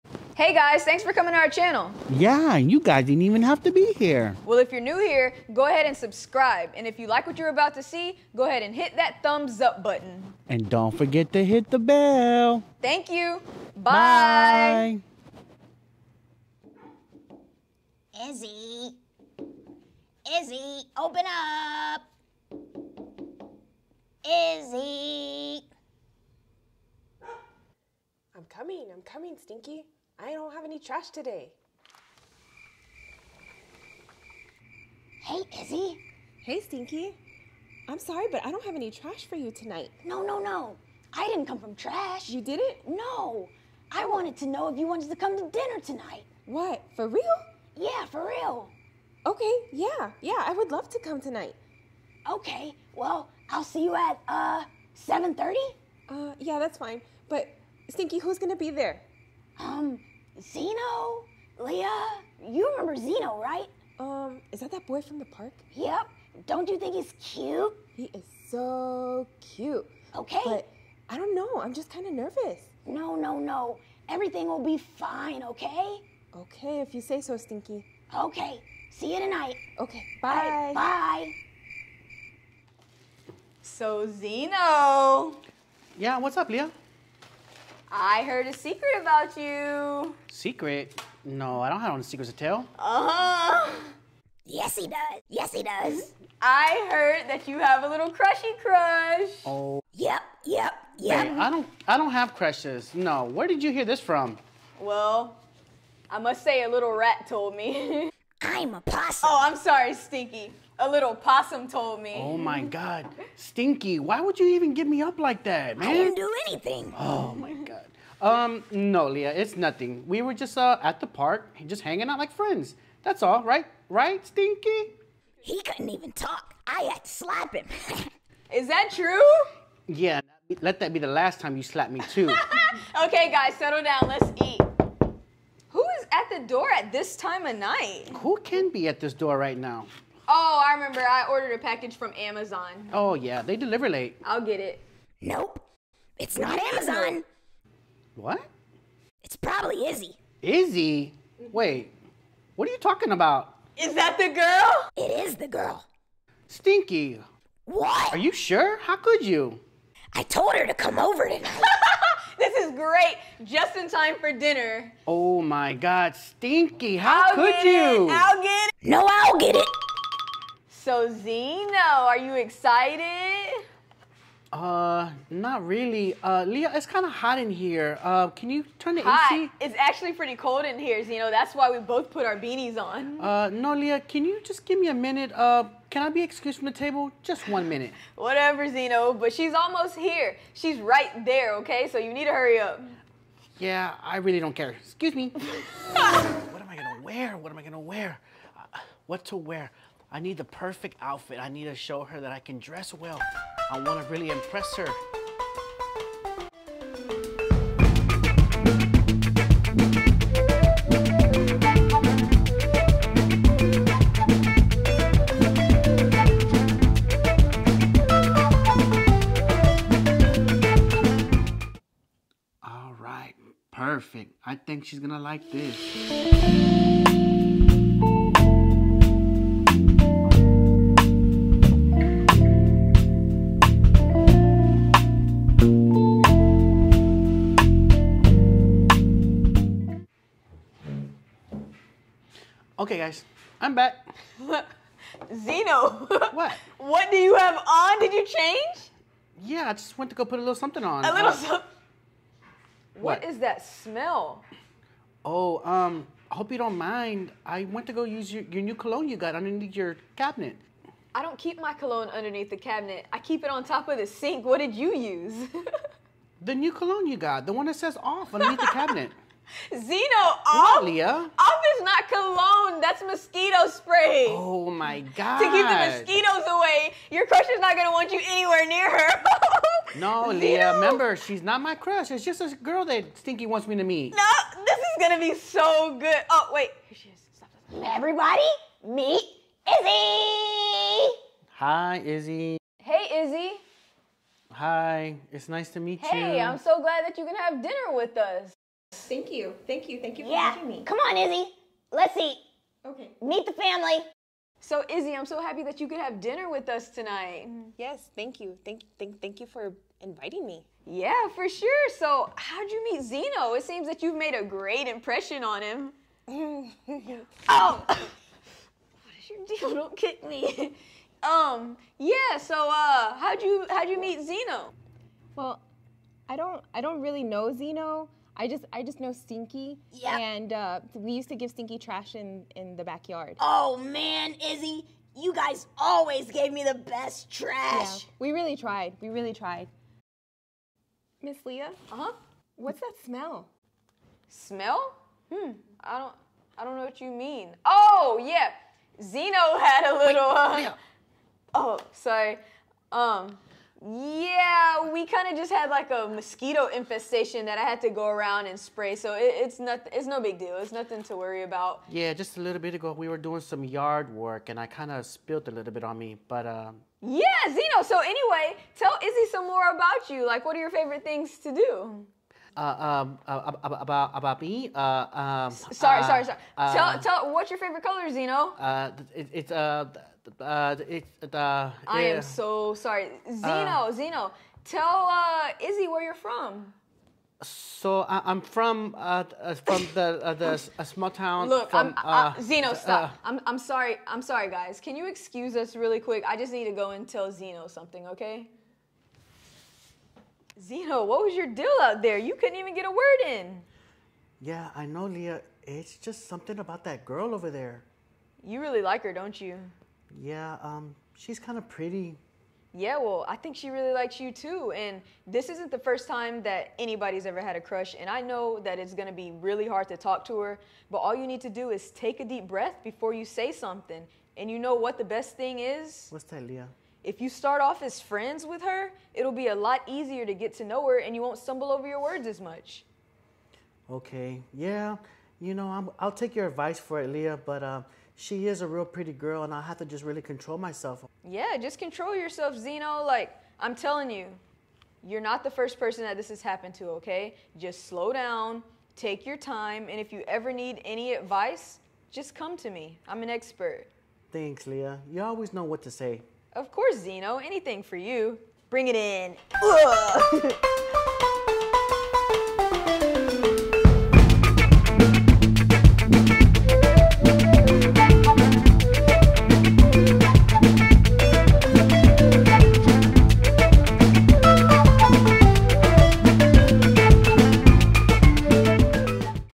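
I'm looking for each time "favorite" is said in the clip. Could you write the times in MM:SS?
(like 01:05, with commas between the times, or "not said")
06:10, 06:17.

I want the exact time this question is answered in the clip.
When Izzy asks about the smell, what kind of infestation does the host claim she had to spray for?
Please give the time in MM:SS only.
05:56.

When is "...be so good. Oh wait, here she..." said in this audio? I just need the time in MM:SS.
04:45.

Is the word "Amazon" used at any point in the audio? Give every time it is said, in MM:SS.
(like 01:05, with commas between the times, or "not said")
02:22, 02:26.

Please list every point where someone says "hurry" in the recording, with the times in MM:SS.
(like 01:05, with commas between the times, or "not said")
03:12.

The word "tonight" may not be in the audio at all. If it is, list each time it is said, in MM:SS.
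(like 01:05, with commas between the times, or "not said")
00:39, 00:45, 00:51, 01:19, 02:41, 05:06.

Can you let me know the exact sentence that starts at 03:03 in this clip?
Uh, no, Leah, can you just give me a minute?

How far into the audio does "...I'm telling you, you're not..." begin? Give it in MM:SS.
07:23.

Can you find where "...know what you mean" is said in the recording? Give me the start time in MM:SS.
05:46.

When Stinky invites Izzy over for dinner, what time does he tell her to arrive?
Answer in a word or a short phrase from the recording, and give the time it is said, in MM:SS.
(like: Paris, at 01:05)
7:30, at 00:54.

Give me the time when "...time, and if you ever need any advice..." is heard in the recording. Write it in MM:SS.
07:29.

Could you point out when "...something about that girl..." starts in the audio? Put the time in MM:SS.
06:46.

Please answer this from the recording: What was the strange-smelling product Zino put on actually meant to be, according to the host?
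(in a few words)
Mosquito spray.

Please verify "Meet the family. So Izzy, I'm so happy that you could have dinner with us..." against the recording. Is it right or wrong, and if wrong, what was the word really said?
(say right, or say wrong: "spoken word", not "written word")
right.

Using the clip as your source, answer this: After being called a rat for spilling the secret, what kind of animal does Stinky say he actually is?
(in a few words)
A possum.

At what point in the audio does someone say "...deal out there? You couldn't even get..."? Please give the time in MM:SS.
06:41.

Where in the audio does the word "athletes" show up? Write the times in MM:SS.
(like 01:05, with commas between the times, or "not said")
not said.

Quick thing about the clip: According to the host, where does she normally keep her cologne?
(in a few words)
On top of the sink.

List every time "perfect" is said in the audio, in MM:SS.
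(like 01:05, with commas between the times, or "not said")
03:20, 03:43.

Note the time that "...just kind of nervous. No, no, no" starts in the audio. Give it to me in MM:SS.
01:11.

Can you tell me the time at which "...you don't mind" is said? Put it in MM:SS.
04:16.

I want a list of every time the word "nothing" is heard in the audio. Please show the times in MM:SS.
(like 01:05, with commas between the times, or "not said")
01:59, 06:00.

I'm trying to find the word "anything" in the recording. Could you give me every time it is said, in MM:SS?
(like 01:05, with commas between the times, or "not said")
01:56, 07:37.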